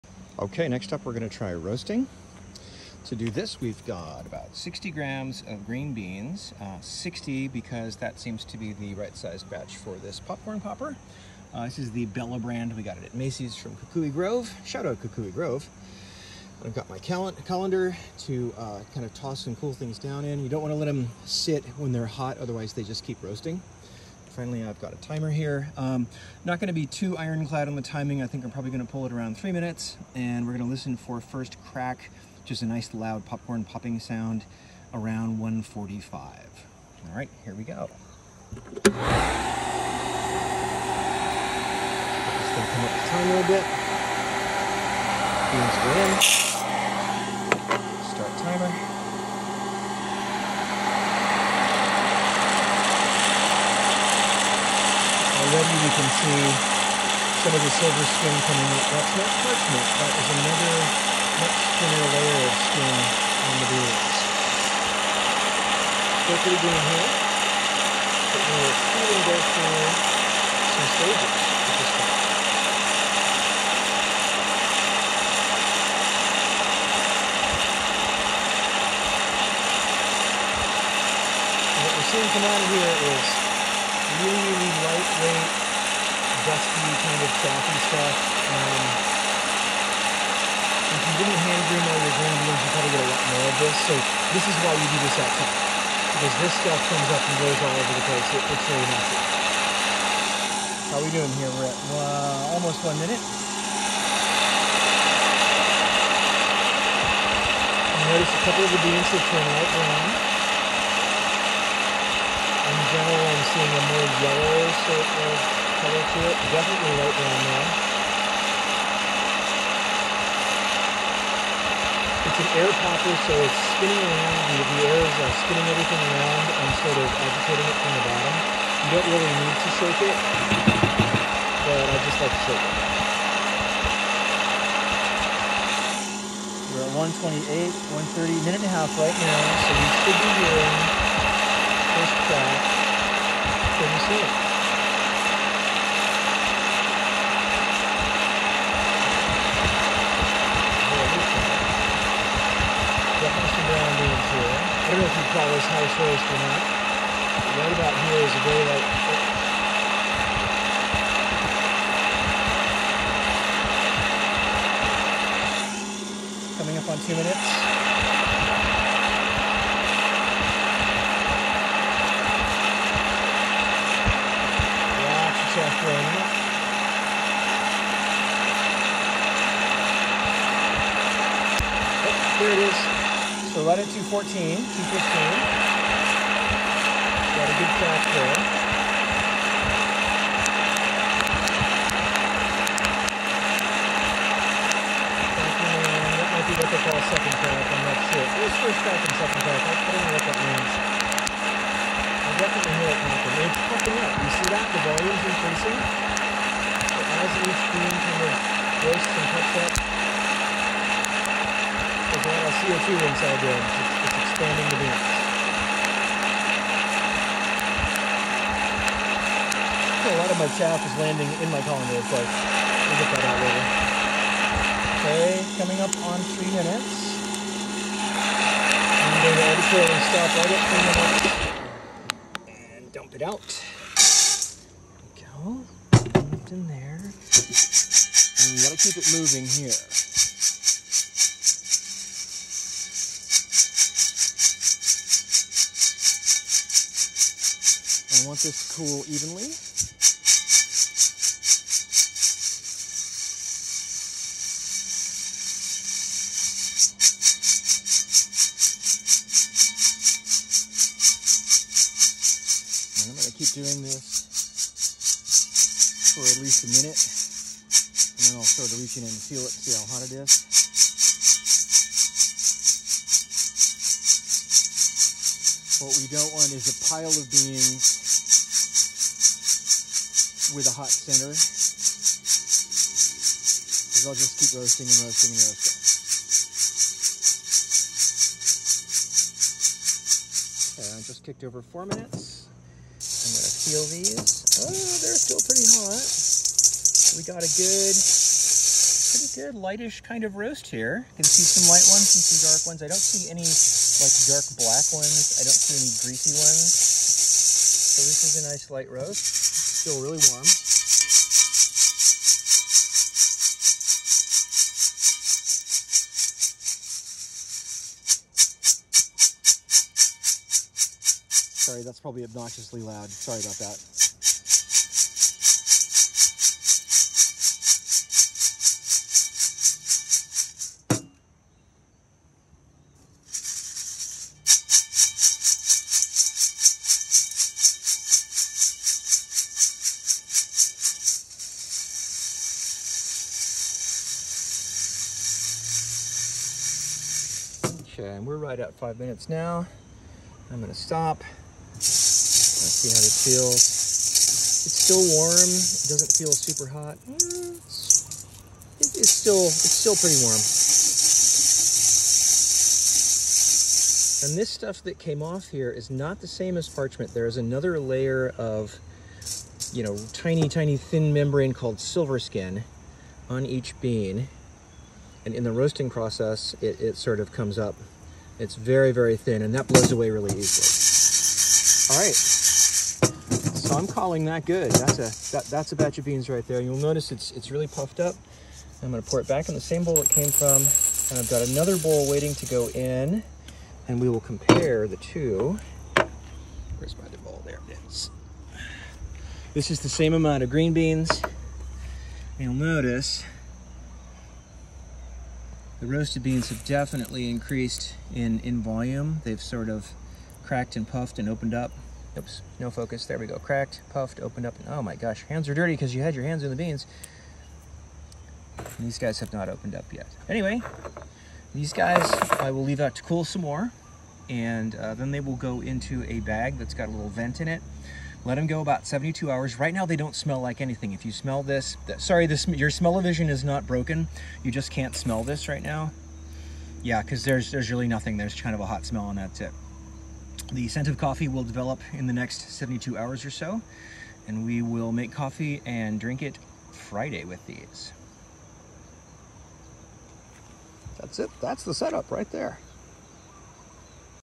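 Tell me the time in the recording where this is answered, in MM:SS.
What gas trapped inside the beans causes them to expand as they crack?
03:32.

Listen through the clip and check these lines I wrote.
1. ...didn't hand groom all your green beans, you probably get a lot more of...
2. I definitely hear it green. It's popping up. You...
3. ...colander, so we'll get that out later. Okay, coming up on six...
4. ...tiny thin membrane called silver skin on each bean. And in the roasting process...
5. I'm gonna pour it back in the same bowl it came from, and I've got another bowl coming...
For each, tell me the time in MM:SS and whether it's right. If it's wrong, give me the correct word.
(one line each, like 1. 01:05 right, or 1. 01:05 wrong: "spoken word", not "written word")
1. 01:31 right
2. 03:21 wrong: "happen", not "green"
3. 03:41 wrong: "three", not "six"
4. 06:10 right
5. 06:28 wrong: "waiting", not "coming".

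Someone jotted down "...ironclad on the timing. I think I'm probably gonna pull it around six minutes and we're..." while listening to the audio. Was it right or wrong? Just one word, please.
wrong.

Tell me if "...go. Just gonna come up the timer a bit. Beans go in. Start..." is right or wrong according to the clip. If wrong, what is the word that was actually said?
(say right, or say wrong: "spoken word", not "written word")
right.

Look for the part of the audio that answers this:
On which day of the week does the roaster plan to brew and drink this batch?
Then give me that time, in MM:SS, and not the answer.
07:26.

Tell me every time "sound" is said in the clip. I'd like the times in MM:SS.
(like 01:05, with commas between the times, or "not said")
00:33.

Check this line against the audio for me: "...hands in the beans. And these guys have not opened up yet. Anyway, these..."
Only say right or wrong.
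right.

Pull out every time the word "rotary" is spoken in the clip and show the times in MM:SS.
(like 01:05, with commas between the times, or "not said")
not said.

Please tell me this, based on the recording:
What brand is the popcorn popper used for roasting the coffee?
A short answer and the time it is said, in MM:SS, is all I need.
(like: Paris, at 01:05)
Bella, at 00:12.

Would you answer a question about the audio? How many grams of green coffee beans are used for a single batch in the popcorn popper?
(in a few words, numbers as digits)
60 grams.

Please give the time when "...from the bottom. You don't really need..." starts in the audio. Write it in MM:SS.
02:07.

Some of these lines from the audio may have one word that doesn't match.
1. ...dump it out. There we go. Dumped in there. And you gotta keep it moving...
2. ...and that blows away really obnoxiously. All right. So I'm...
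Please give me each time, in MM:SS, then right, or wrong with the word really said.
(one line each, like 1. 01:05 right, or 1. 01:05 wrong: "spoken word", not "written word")
1. 03:52 right
2. 06:19 wrong: "easily", not "obnoxiously".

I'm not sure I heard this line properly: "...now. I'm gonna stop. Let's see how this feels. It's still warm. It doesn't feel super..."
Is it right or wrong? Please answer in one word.
right.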